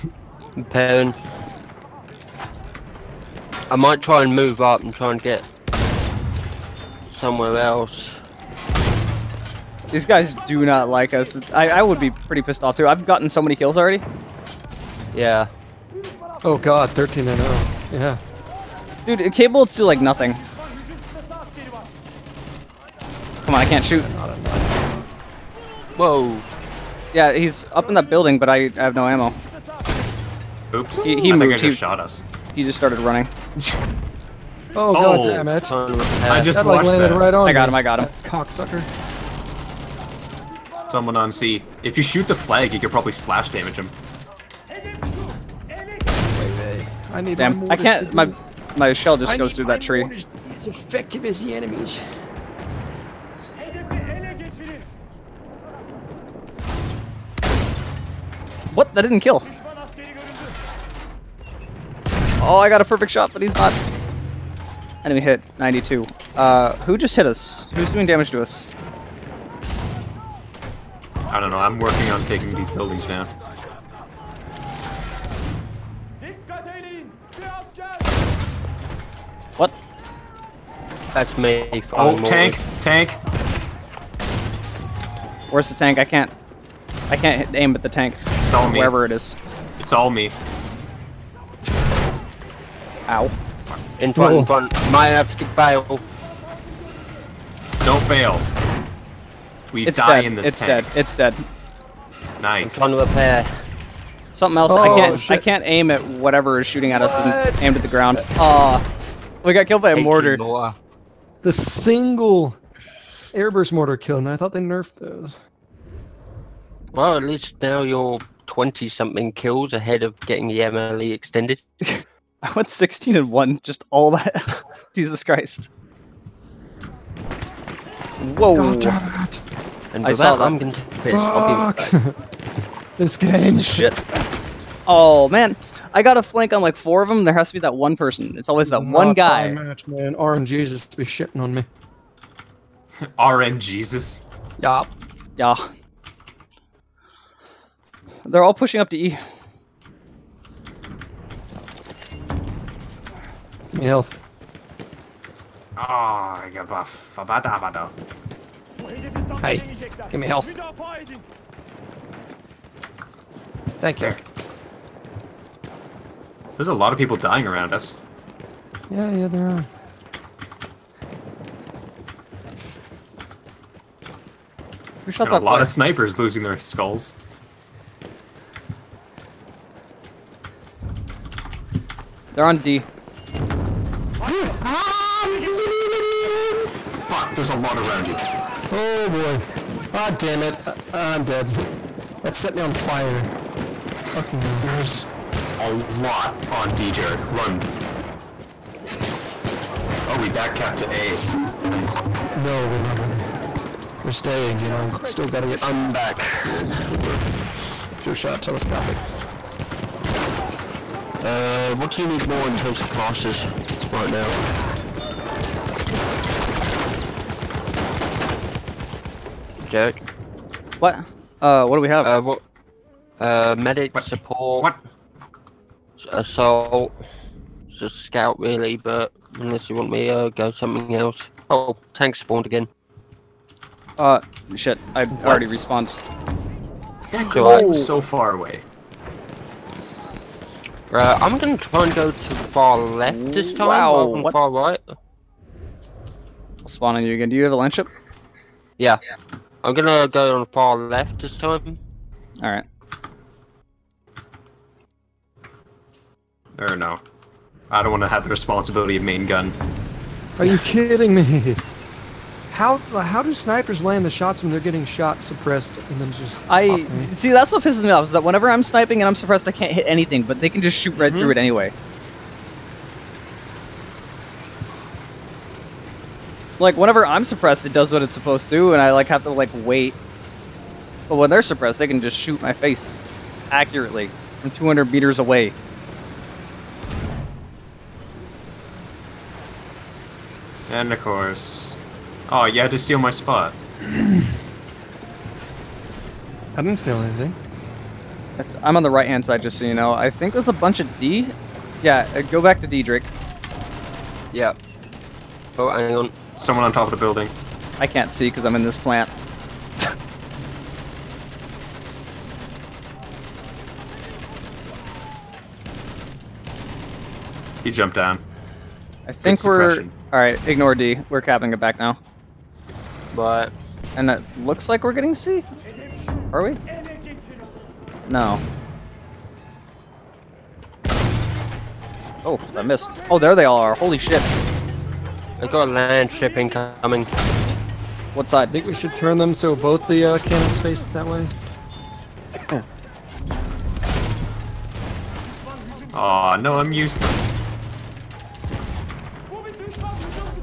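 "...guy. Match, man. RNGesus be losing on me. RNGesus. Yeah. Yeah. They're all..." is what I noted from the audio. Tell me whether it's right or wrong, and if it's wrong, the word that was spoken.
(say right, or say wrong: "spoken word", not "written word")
wrong: "shitting", not "losing".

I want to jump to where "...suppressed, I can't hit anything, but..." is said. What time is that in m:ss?
4:29.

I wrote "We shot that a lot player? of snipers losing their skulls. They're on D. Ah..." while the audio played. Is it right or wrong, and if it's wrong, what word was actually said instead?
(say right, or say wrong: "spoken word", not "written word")
right.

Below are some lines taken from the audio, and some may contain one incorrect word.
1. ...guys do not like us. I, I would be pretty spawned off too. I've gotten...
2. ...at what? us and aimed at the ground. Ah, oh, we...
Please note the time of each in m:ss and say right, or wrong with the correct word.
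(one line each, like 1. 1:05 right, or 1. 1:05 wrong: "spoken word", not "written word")
1. 0:10 wrong: "pissed", not "spawned"
2. 1:46 right.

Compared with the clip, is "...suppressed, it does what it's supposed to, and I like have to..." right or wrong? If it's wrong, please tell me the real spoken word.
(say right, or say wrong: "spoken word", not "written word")
right.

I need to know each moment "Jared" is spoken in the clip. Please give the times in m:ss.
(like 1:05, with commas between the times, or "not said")
3:16.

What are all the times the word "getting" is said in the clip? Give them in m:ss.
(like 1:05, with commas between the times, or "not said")
2:00, 4:24, 5:24.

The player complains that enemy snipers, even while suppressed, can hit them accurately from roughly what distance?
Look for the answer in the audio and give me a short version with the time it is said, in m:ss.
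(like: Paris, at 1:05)
200 meters, at 4:44.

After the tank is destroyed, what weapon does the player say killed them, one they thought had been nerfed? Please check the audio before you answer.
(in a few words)
airburst mortar.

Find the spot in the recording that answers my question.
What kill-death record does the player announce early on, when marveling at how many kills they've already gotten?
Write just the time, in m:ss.
0:16.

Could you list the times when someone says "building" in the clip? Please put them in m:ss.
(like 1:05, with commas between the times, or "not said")
0:28, 1:12, 5:06.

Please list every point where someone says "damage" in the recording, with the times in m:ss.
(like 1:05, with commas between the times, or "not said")
0:43, 1:08.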